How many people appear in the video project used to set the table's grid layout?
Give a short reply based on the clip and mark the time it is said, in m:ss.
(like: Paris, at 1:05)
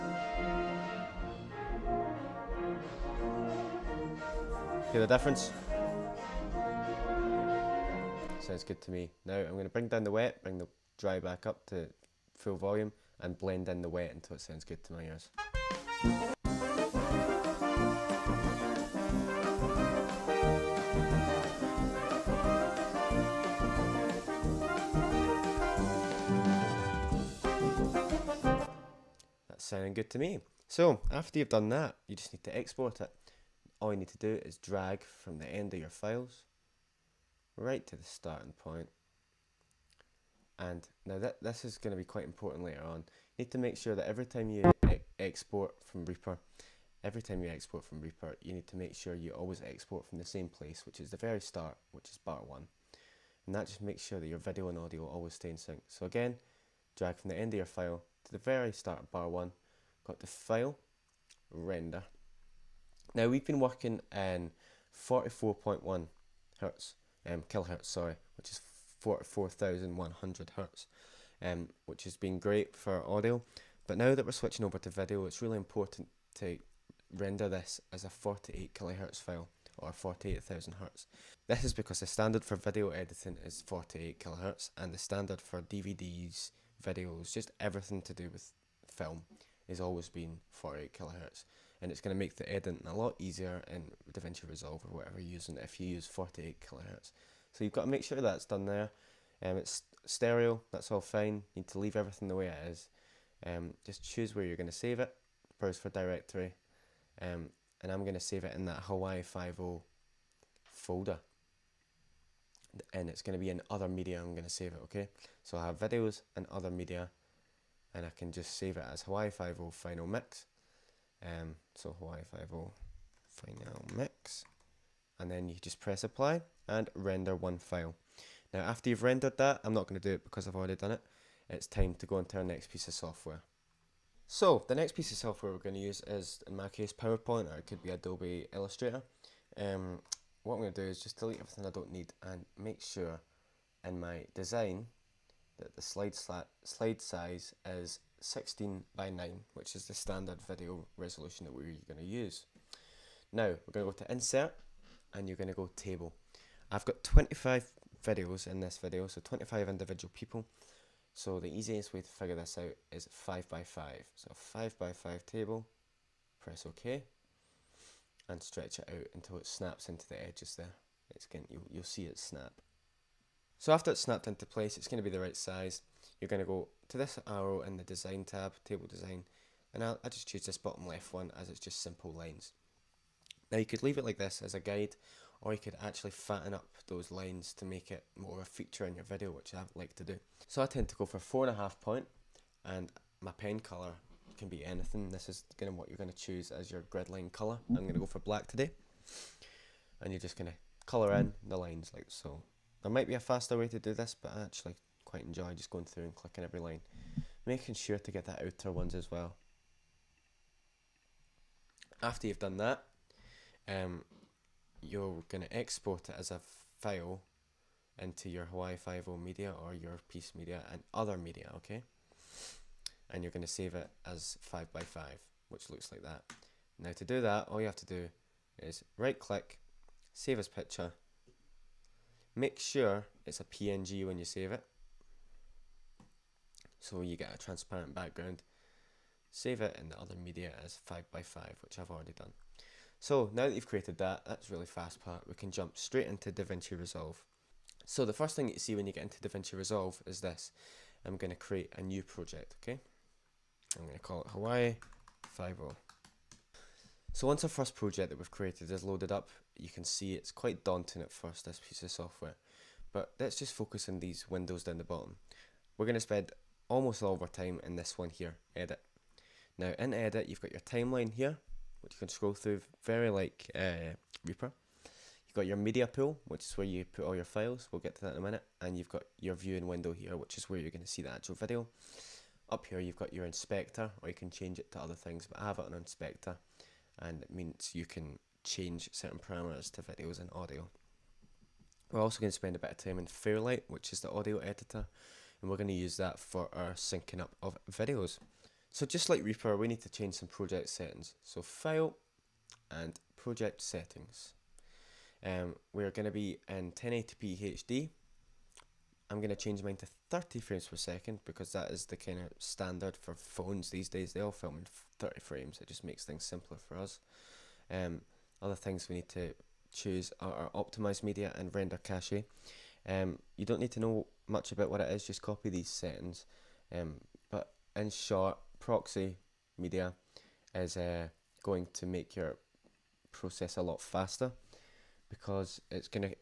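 25, at 2:39.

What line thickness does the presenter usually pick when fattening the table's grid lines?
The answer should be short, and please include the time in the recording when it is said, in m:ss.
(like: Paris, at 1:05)
4.5 point, at 3:11.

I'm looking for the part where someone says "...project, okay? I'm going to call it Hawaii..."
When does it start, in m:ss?
4:12.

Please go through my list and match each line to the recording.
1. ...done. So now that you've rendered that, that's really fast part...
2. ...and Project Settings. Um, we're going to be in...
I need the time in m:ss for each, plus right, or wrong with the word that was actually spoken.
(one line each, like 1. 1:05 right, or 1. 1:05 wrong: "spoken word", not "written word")
1. 4:02 wrong: "created", not "rendered"
2. 5:02 right.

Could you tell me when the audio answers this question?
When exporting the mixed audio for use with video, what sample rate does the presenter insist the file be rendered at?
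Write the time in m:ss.
1:18.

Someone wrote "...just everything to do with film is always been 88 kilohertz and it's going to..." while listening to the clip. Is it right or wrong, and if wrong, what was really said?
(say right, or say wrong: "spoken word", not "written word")
wrong: "48", not "88".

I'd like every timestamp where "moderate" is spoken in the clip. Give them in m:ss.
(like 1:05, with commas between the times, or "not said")
not said.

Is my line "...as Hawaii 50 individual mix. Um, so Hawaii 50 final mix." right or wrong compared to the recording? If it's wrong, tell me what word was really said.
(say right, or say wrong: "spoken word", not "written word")
wrong: "final", not "individual".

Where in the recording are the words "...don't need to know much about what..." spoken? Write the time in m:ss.
5:23.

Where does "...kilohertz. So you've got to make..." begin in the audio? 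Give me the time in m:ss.
1:36.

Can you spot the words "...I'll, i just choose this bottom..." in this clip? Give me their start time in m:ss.
2:59.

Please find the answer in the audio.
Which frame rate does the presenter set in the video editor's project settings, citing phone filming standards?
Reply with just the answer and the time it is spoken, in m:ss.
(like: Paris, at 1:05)
30 frames per second, at 5:10.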